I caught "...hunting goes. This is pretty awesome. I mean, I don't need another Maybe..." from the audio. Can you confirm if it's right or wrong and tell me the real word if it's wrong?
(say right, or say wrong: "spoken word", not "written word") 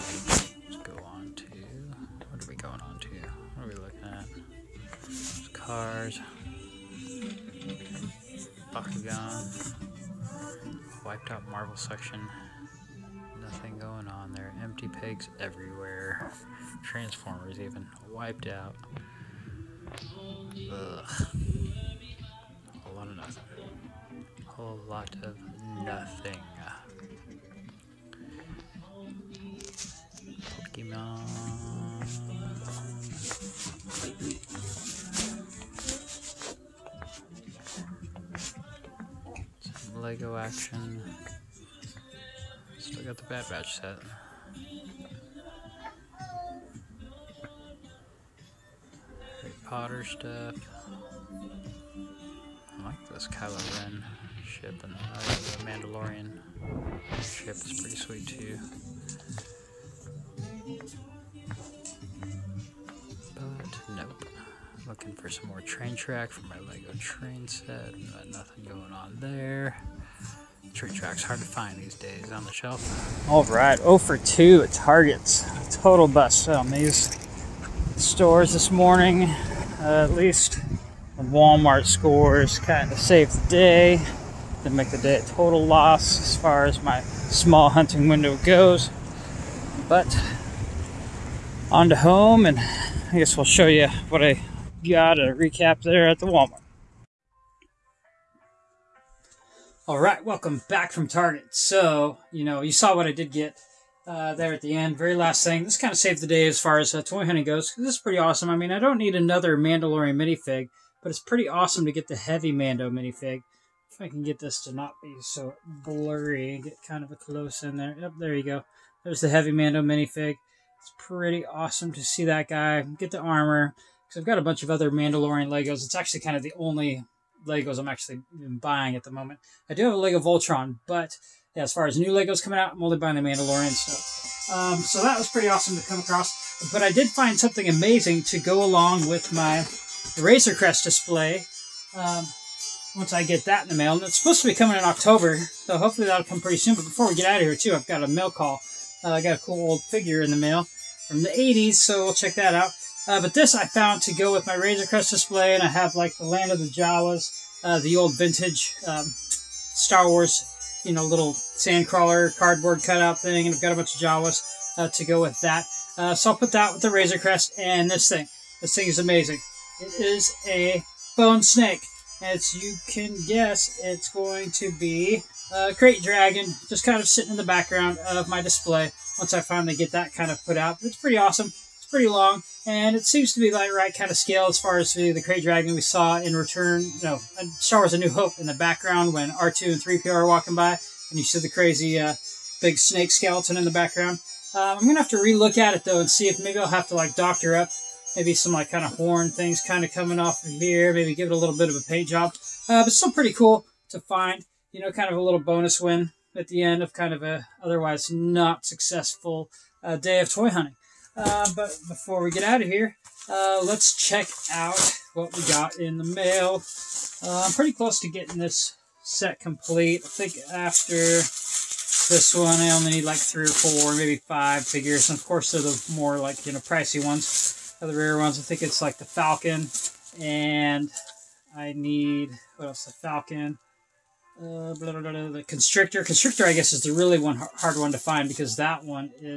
wrong: "Mandalorian", not "Maybe".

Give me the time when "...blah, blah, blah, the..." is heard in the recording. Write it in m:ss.
3:54.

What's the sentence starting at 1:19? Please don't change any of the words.
Uh, at least Walmart scores kind of saved the day.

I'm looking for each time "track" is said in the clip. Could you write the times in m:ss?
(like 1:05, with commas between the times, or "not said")
1:05, 1:10.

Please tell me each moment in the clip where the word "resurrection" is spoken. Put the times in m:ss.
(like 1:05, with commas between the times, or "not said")
not said.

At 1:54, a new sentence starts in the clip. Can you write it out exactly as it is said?
I can get this to not be so blurry and get kind of a close in there.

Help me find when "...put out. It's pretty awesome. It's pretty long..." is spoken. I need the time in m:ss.
3:00.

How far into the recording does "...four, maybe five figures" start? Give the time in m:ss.
3:43.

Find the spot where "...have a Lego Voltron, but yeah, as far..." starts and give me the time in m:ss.
2:09.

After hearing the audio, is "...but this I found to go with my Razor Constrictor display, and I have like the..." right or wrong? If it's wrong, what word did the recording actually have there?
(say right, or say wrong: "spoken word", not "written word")
wrong: "Crest", not "Constrictor".